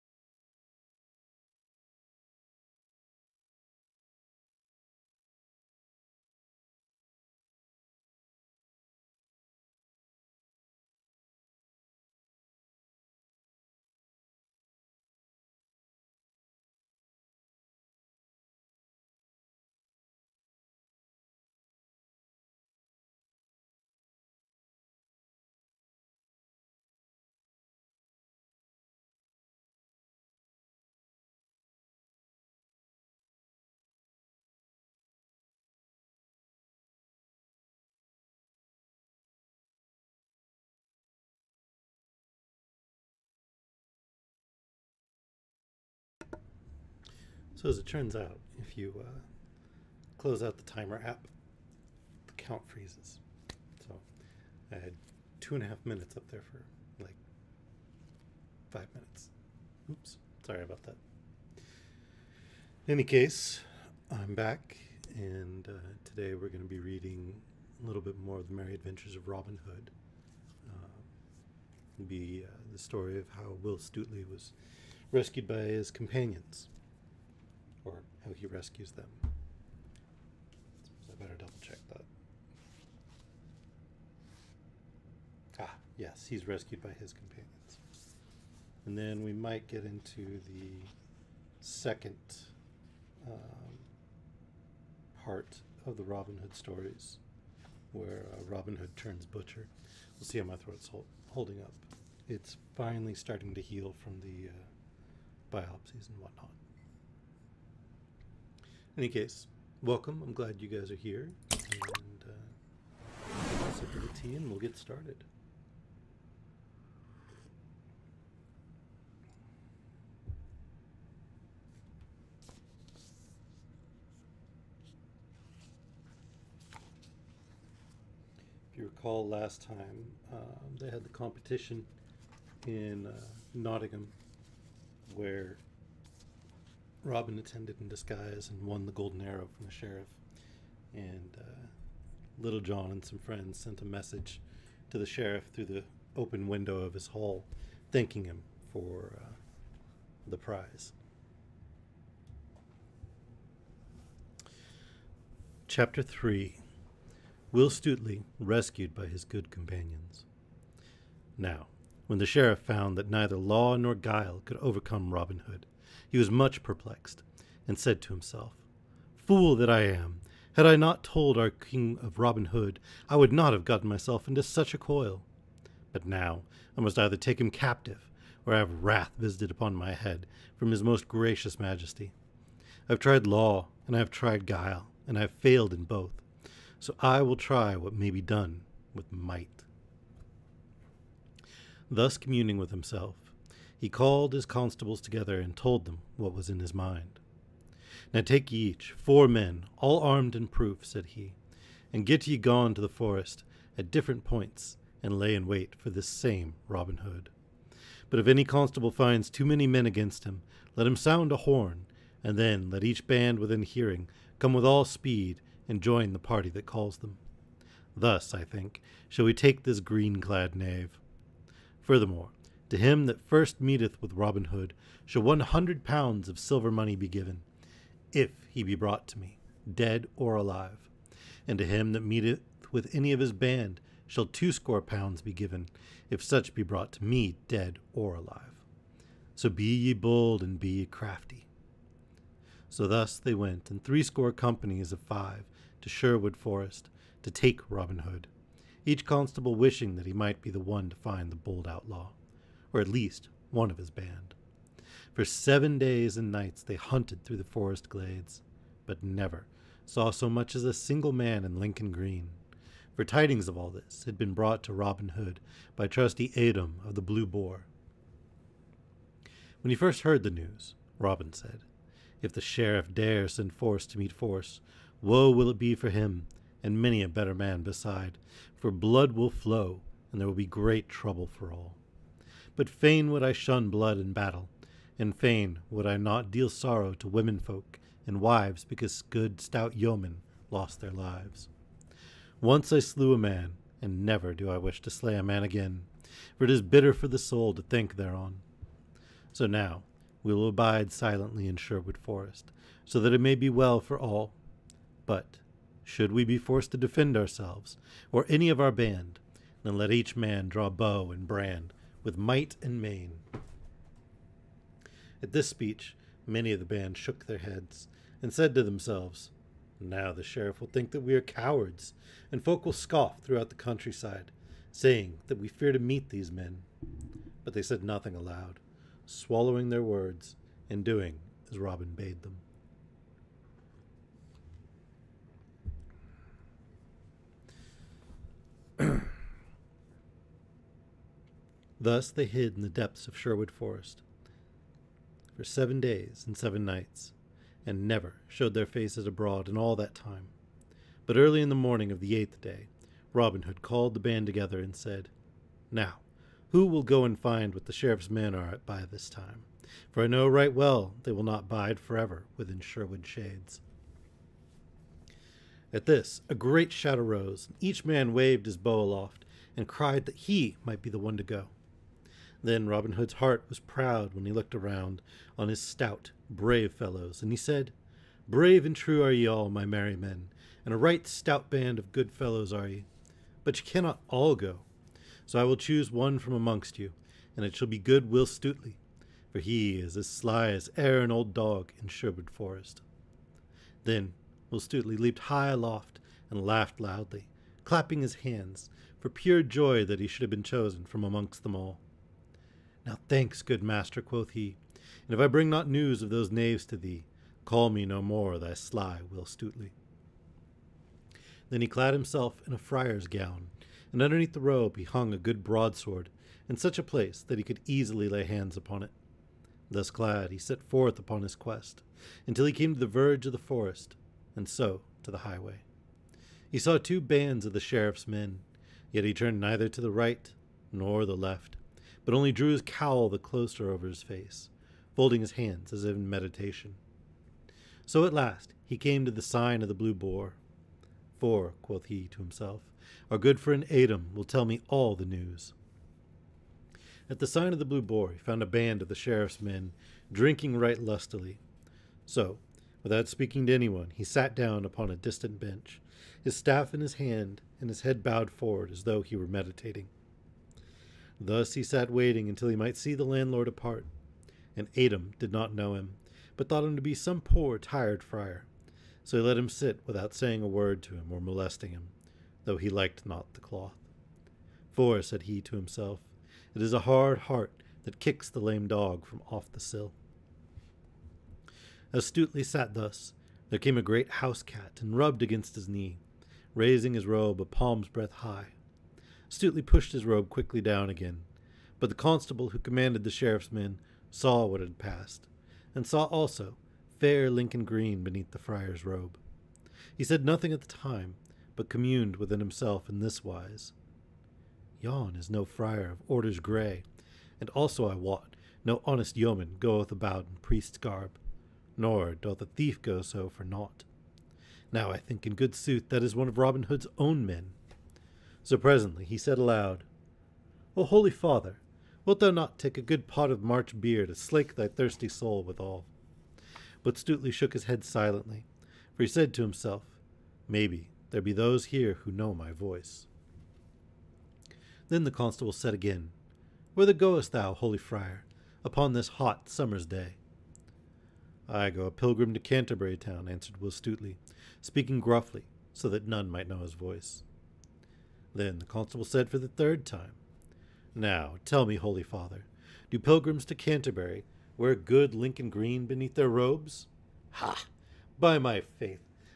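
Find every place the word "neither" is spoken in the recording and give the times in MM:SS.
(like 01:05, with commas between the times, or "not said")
02:43, 07:09.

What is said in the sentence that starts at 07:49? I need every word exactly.
So he let him sit without saying a word to him or molesting him, though he liked not the cloth.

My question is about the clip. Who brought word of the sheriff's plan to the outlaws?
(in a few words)
Adam of the Blue Boar.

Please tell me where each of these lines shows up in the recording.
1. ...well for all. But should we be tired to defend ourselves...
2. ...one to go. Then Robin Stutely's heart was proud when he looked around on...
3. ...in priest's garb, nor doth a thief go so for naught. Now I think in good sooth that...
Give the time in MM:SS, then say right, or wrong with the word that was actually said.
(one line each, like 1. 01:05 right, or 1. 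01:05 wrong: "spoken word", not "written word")
1. 05:03 wrong: "forced", not "tired"
2. 06:10 wrong: "Hood", not "Stutely"
3. 08:30 right.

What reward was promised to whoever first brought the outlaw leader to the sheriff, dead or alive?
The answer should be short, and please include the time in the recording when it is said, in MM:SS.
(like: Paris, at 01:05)
100 pounds, at 03:45.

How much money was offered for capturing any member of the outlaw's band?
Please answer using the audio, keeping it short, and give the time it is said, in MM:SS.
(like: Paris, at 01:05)
twoscore pounds, at 03:54.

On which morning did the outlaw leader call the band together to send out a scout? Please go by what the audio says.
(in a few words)
the eighth day.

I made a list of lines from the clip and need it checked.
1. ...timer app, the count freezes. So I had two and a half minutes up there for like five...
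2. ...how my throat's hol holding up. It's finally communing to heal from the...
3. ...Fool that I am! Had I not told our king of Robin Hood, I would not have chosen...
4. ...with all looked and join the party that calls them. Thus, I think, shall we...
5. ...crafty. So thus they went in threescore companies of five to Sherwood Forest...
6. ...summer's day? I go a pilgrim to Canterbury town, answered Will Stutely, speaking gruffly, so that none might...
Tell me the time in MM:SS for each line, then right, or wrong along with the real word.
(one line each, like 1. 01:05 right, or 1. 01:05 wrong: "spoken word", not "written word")
1. 00:50 right
2. 01:40 wrong: "starting", not "communing"
3. 02:49 wrong: "gotten", not "chosen"
4. 03:34 wrong: "speed", not "looked"
5. 04:00 right
6. 08:59 right.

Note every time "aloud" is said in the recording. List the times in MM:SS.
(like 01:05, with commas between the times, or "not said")
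05:28, 08:39.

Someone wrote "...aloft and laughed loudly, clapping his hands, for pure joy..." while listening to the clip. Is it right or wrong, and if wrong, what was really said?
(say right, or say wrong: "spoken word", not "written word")
right.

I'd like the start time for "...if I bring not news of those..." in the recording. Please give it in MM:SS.
06:45.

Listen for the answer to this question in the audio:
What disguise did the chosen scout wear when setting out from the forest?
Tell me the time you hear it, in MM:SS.
06:52.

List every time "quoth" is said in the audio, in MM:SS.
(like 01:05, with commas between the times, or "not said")
06:44, 07:21.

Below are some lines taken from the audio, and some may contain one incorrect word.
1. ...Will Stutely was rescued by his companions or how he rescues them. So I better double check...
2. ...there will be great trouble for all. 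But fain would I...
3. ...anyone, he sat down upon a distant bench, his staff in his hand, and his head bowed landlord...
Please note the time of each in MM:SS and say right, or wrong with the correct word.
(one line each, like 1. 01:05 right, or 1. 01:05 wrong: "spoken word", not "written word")
1. 01:13 right
2. 04:40 right
3. 07:33 wrong: "forward", not "landlord".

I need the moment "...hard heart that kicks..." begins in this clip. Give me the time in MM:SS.
07:56.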